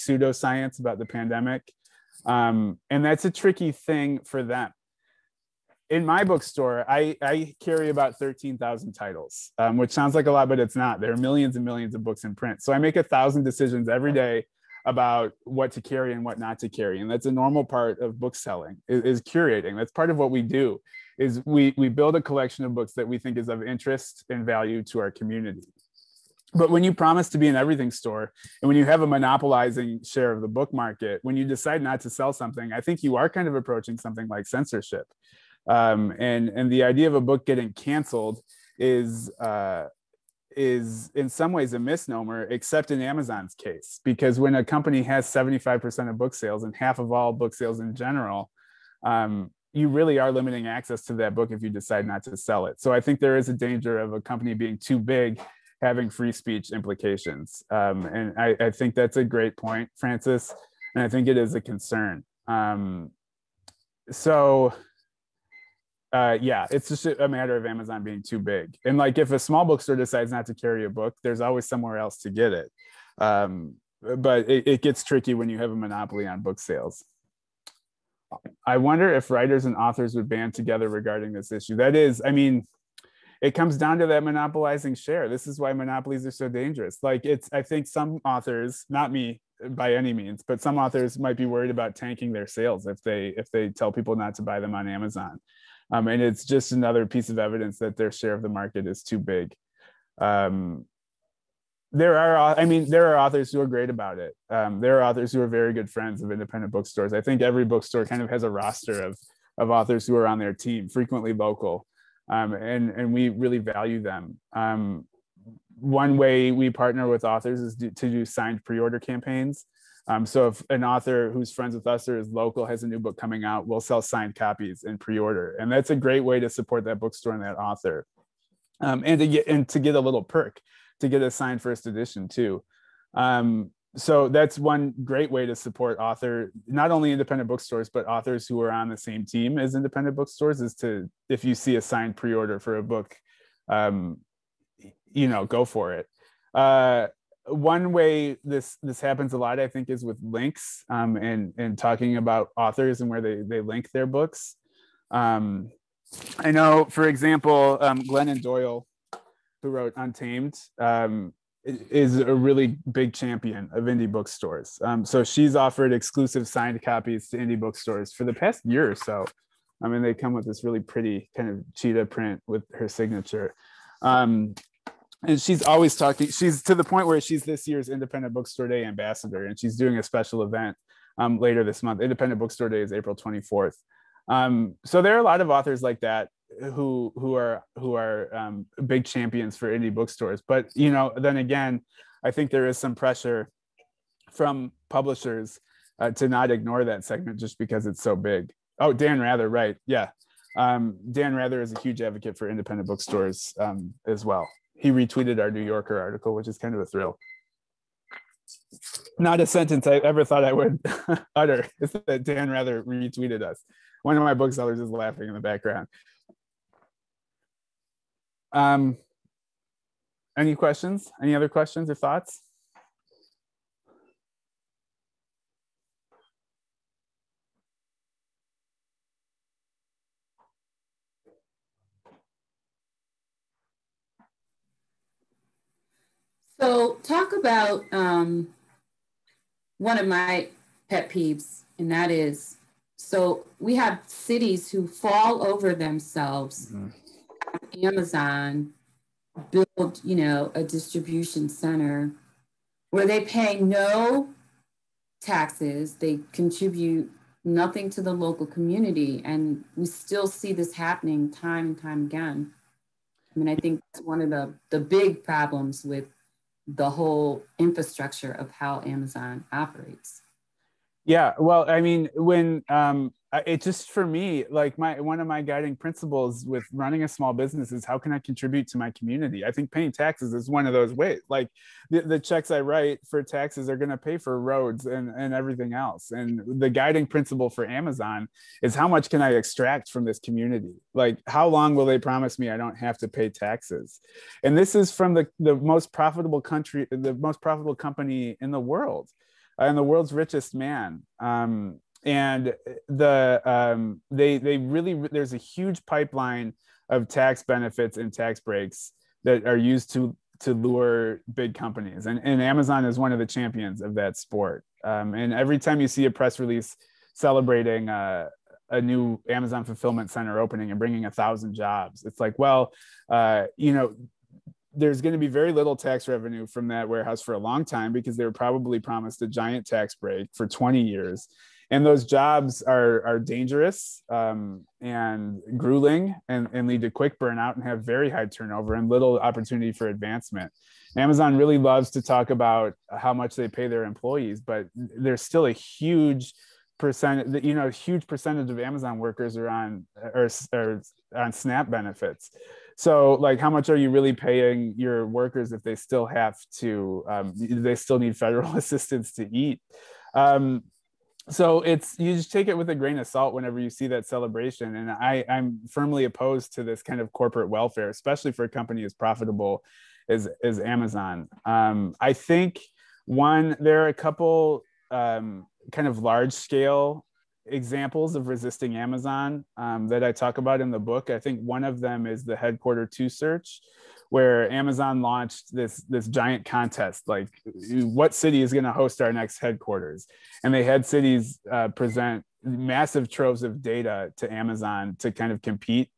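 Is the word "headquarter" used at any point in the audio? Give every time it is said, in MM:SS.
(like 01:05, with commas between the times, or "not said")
06:22, 06:29.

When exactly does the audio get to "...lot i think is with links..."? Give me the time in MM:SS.
02:29.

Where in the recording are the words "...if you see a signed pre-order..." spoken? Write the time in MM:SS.
02:21.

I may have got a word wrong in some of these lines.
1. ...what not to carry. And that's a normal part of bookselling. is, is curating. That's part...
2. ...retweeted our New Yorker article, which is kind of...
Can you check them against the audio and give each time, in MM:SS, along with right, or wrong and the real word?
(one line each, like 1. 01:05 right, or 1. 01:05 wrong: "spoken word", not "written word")
1. 00:16 right
2. 03:24 right.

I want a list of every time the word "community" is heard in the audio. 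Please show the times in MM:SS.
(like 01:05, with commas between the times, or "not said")
00:25, 04:18, 04:38, 04:50.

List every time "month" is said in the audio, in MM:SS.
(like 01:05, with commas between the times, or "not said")
03:01.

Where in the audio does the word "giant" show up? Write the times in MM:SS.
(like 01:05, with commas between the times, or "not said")
05:29, 06:26.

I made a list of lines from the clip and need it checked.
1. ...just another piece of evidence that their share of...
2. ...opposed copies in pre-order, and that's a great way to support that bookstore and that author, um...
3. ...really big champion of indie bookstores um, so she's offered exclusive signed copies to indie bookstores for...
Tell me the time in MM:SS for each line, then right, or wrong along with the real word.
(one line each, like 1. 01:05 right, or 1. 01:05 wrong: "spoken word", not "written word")
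1. 01:36 right
2. 02:04 wrong: "signed", not "opposed"
3. 02:42 right.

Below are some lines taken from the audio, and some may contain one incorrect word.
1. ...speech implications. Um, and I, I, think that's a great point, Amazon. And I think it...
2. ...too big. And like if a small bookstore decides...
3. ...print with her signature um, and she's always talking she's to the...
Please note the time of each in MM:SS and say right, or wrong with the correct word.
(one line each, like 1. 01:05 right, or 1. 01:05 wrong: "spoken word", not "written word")
1. 00:56 wrong: "Francis", not "Amazon"
2. 01:08 right
3. 02:52 right.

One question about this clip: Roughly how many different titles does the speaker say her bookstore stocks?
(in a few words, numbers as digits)
13,000.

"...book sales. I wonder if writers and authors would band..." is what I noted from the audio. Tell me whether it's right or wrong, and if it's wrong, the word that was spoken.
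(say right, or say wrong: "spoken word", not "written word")
right.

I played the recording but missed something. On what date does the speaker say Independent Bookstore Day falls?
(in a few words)
April 24th.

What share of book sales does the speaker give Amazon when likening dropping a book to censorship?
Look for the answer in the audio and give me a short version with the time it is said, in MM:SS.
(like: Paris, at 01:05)
75%, at 00:45.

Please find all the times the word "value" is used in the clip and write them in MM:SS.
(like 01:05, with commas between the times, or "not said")
00:24, 01:53.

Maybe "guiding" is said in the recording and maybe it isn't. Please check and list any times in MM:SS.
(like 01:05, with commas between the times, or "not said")
04:35, 04:46.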